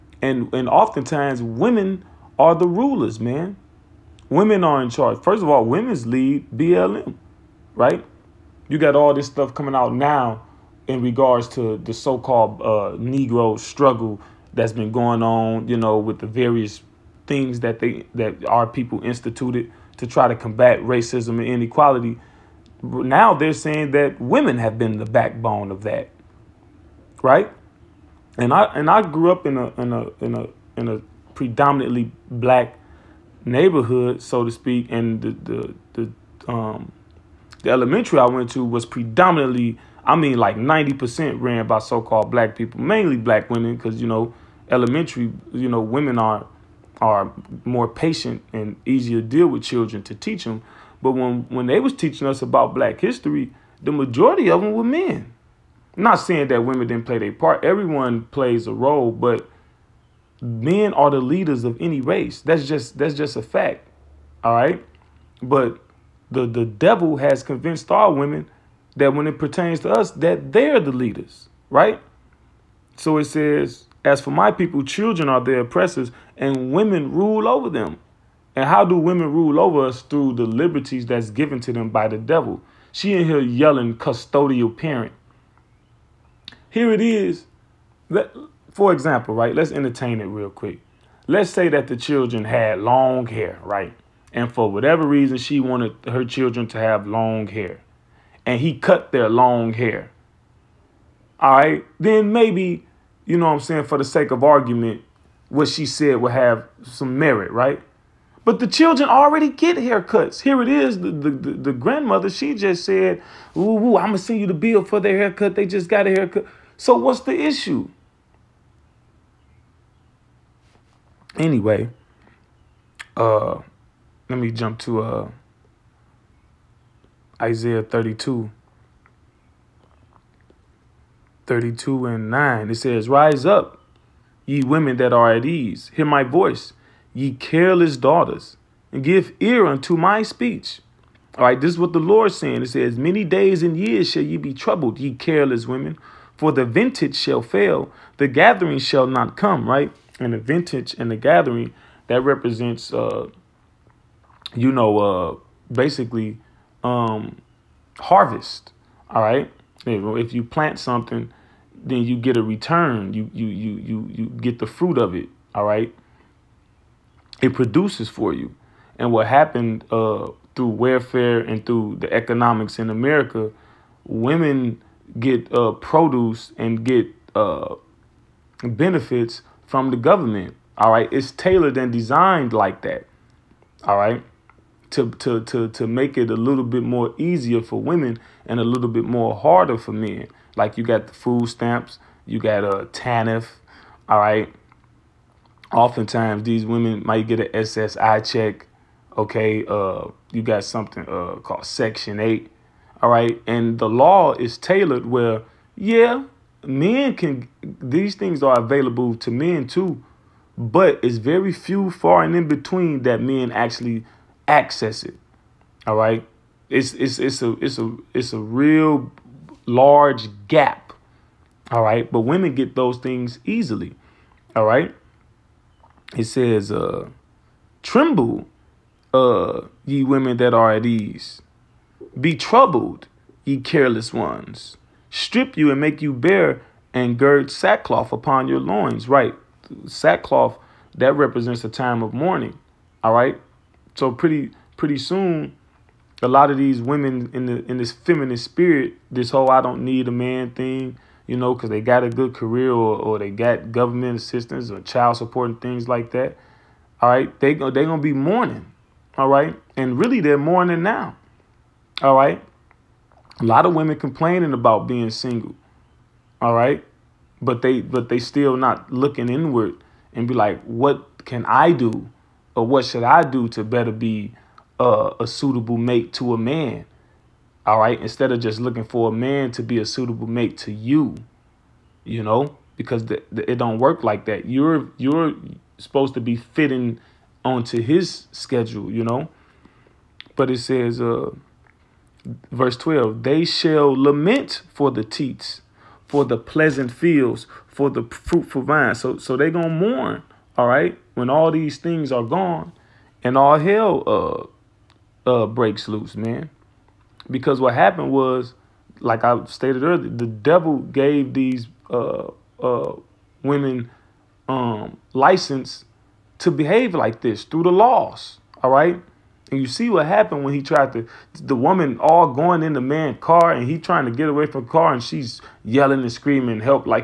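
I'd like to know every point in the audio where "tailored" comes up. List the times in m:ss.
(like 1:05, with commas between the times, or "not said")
3:01, 3:24.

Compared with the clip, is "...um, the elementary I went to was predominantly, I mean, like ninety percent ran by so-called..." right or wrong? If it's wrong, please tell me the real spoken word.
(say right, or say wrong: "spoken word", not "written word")
right.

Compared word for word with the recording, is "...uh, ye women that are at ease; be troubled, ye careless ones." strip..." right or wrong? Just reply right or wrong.
right.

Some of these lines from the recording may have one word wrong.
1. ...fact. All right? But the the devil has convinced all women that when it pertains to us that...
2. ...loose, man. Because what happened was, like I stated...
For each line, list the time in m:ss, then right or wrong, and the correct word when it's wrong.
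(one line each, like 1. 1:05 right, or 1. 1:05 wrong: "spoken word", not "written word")
1. 1:03 right
2. 5:05 right.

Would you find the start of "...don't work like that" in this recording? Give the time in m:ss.
4:43.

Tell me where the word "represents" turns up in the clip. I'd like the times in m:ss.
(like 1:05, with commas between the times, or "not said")
2:32, 4:01.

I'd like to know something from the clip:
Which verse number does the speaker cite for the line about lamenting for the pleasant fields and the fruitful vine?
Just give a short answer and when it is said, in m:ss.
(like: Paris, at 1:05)
Verse 12, at 4:52.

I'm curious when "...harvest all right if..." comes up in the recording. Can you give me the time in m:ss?
2:37.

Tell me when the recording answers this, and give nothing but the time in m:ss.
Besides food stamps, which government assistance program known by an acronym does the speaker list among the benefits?
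3:12.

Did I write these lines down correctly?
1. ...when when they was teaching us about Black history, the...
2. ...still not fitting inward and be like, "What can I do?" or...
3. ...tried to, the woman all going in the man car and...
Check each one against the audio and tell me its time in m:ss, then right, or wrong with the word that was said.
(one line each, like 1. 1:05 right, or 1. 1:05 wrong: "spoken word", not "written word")
1. 0:51 right
2. 4:28 wrong: "looking", not "fitting"
3. 5:20 right.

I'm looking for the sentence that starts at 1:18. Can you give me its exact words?
And how do women rule over us through the liberties that's given to them by the devil?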